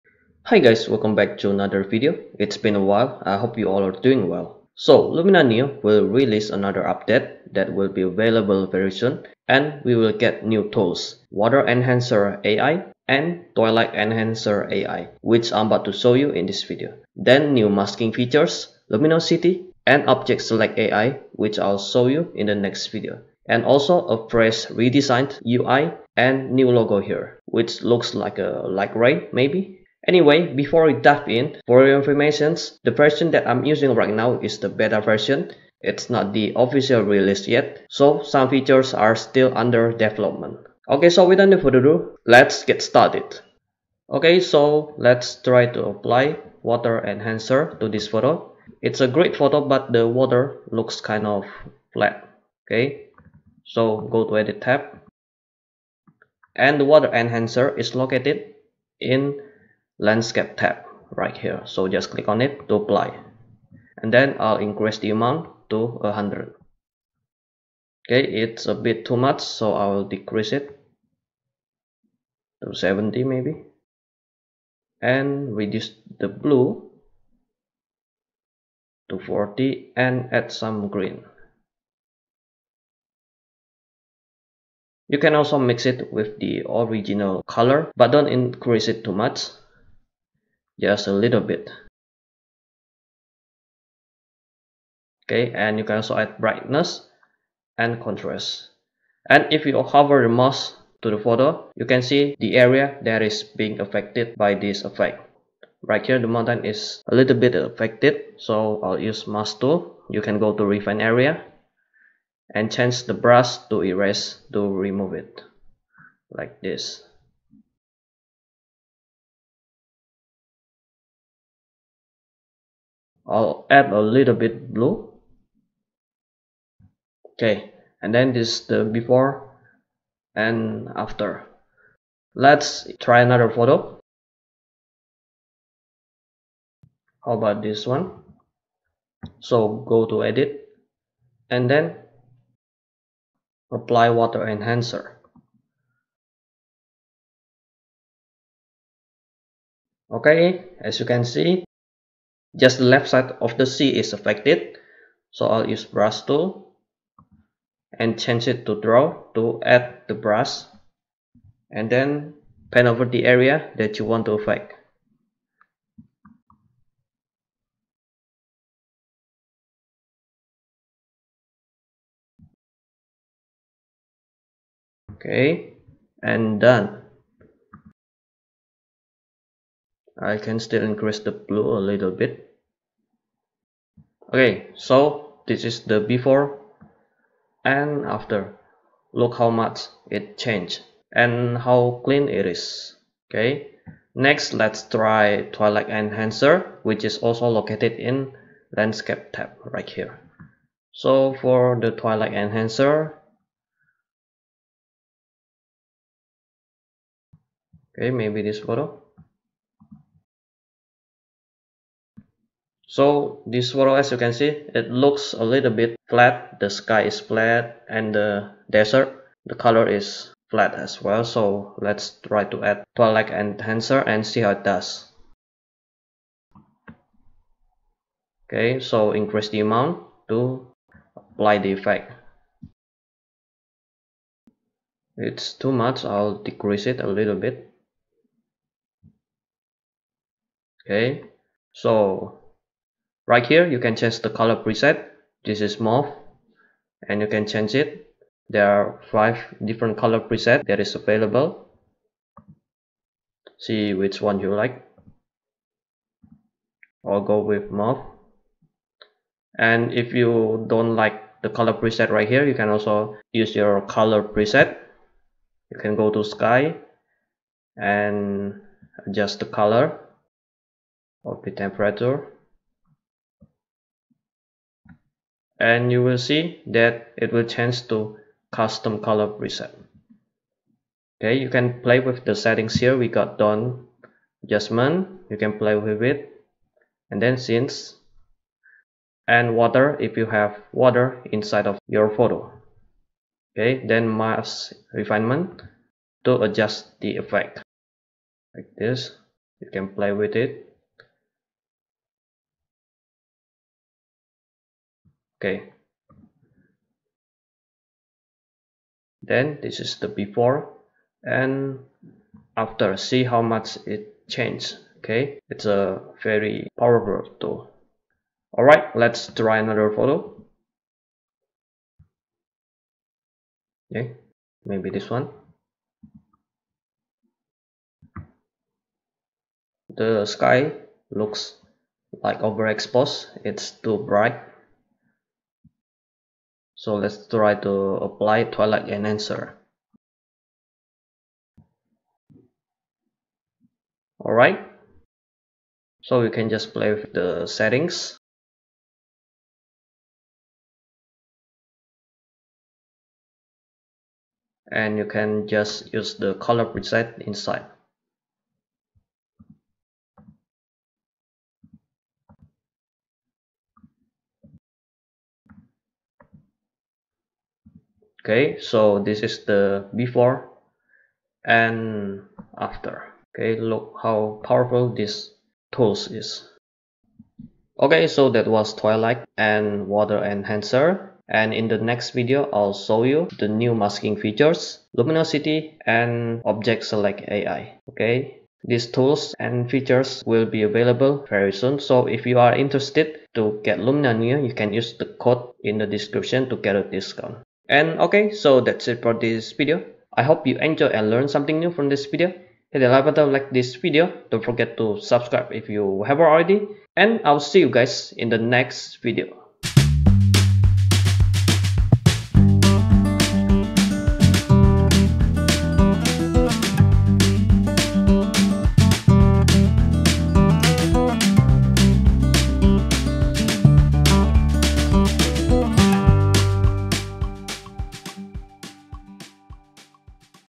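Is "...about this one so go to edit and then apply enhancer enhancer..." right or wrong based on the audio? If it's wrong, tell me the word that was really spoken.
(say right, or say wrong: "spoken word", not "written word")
wrong: "water", not "enhancer".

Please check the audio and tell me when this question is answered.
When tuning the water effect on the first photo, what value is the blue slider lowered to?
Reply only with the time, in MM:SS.
01:19.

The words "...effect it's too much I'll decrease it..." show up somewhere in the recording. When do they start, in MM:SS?
03:51.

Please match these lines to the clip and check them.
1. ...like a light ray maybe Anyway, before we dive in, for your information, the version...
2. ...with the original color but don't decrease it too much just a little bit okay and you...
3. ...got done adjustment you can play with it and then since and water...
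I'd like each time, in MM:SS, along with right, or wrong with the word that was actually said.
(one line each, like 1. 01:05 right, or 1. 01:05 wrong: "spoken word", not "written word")
1. 00:28 right
2. 01:26 wrong: "increase", not "decrease"
3. 04:43 right.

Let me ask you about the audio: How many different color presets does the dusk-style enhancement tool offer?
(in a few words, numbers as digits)
5.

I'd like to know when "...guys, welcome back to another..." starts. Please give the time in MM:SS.
00:00.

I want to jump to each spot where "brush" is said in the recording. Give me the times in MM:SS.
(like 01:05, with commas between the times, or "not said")
01:53, 02:35, 02:40.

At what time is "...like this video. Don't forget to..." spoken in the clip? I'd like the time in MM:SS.
06:43.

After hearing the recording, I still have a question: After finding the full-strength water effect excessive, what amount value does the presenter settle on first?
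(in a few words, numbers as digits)
70.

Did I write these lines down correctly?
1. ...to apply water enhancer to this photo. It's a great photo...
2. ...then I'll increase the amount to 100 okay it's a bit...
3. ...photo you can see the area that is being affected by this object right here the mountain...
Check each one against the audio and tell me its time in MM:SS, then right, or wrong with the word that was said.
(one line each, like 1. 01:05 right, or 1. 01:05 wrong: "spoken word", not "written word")
1. 00:45 right
2. 01:04 right
3. 01:41 wrong: "effect", not "object".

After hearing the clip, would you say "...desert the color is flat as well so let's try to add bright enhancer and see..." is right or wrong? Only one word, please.
wrong.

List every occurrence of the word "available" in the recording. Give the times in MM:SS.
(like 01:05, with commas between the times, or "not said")
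00:08, 04:11, 06:30.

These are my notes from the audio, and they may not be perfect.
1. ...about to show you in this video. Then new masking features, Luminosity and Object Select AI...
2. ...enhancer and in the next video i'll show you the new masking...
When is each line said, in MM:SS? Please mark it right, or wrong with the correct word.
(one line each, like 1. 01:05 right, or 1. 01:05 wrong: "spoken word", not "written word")
1. 00:15 right
2. 06:20 right.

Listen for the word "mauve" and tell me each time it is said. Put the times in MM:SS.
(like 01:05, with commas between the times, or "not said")
04:05, 04:17.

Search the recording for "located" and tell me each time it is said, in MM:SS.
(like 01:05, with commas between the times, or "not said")
00:57, 03:17.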